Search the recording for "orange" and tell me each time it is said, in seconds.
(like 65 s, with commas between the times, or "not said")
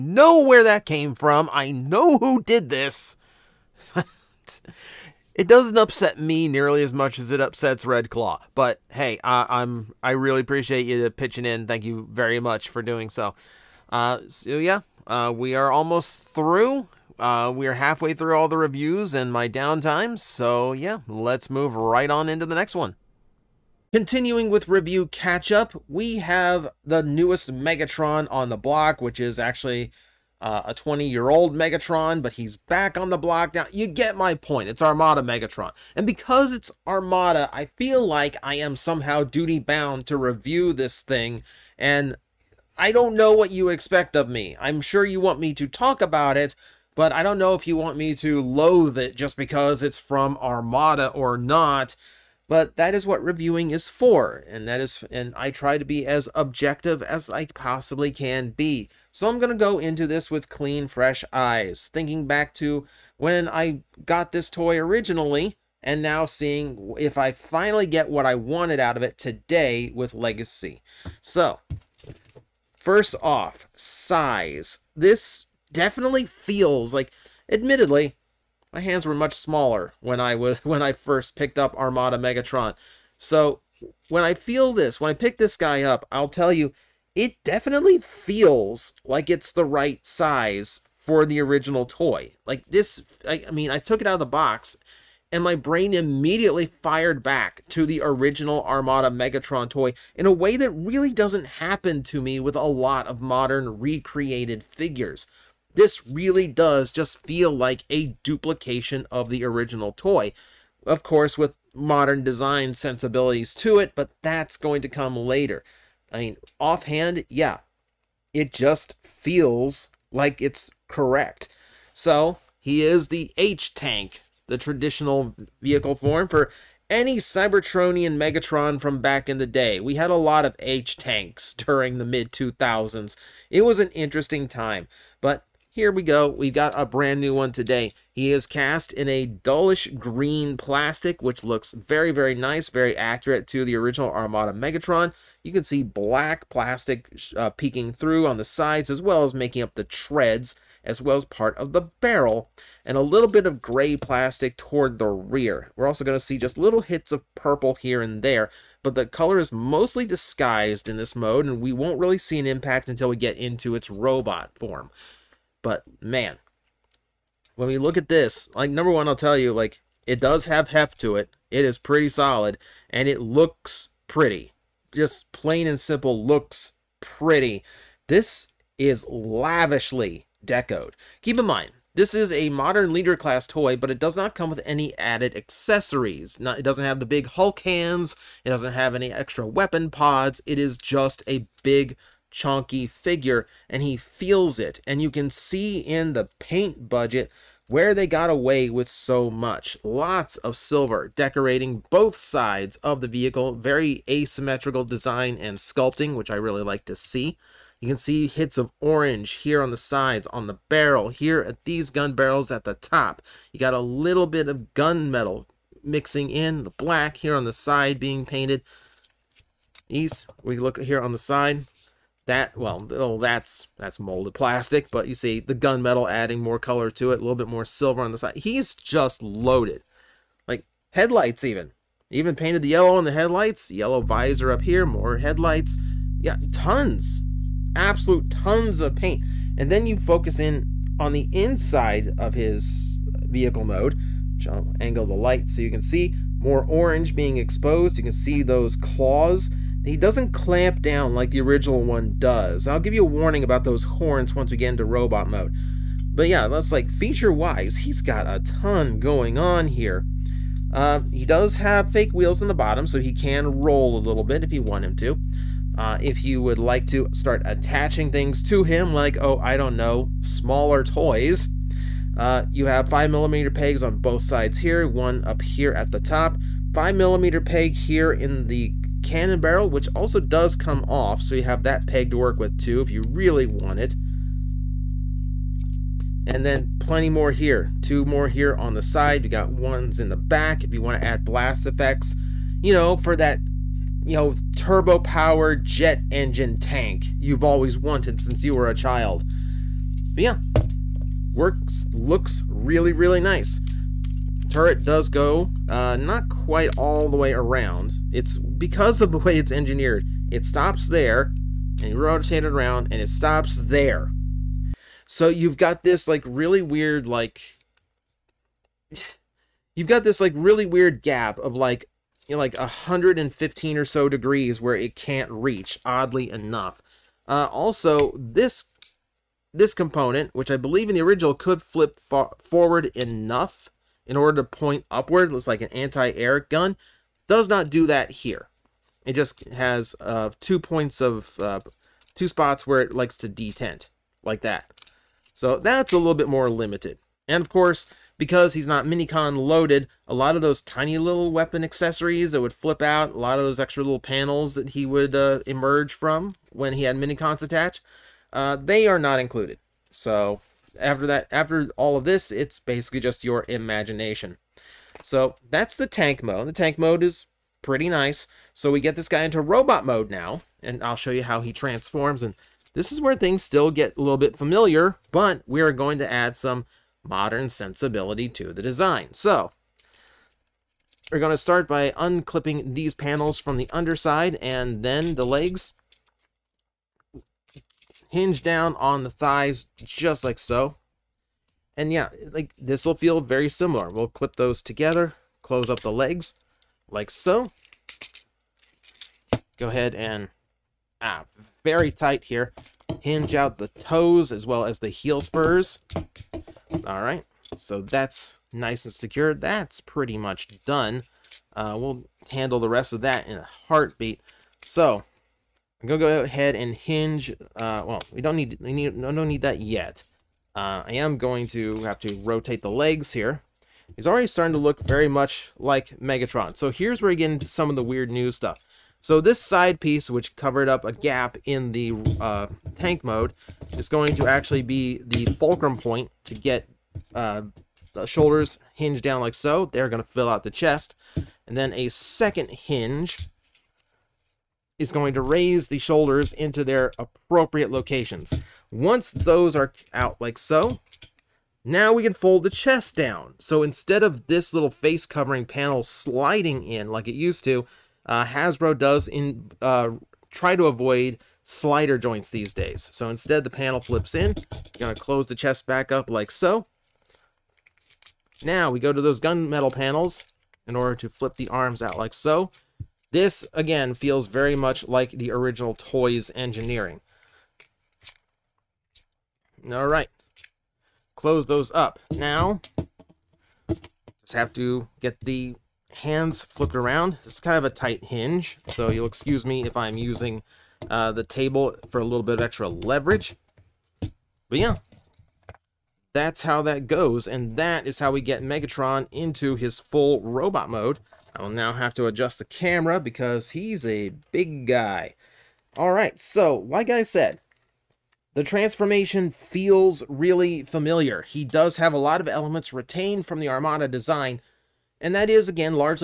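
208 s, 246 s.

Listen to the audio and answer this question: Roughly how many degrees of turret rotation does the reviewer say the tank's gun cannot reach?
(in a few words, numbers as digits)
115.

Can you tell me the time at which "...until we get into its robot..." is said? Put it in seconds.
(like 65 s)
162 s.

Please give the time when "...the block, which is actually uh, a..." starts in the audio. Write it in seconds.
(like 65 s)
28 s.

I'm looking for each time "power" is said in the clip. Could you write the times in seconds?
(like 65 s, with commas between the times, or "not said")
294 s.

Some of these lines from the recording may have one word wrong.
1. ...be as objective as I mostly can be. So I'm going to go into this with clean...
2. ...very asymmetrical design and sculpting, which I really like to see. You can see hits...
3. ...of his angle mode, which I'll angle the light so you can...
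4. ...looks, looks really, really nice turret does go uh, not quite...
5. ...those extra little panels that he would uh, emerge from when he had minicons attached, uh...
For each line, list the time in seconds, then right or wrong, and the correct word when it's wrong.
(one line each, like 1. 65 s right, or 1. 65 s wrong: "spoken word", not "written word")
1. 55 s wrong: "possibly", not "mostly"
2. 203 s right
3. 242 s wrong: "vehicle", not "angle"
4. 301 s wrong: "works", not "looks"
5. 353 s right.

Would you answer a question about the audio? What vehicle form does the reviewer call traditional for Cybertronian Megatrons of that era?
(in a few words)
H-Tank.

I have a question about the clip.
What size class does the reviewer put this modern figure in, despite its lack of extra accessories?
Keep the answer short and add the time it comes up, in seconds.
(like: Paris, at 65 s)
leader class, at 182 s.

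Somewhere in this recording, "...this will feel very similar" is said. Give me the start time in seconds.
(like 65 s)
392 s.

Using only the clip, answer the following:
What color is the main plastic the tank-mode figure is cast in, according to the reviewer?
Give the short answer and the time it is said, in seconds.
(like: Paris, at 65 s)
dullish green, at 139 s.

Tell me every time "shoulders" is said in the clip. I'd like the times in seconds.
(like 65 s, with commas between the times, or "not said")
438 s, 445 s.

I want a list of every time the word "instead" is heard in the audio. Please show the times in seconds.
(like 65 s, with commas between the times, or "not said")
453 s, 463 s.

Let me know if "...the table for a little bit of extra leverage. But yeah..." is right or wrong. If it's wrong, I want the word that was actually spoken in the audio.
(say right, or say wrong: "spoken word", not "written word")
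right.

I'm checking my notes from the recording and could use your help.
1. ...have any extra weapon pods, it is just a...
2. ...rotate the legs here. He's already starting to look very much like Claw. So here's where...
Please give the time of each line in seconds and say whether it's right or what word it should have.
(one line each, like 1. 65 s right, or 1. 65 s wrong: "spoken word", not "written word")
1. 188 s right
2. 422 s wrong: "Megatron", not "Claw".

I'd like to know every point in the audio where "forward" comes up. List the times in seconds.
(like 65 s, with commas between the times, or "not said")
331 s.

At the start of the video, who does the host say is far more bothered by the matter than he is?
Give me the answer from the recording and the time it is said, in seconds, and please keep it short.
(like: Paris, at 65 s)
Red Claw, at 7 s.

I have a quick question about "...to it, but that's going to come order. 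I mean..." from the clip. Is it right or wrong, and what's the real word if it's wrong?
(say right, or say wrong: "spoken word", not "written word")
wrong: "later", not "order".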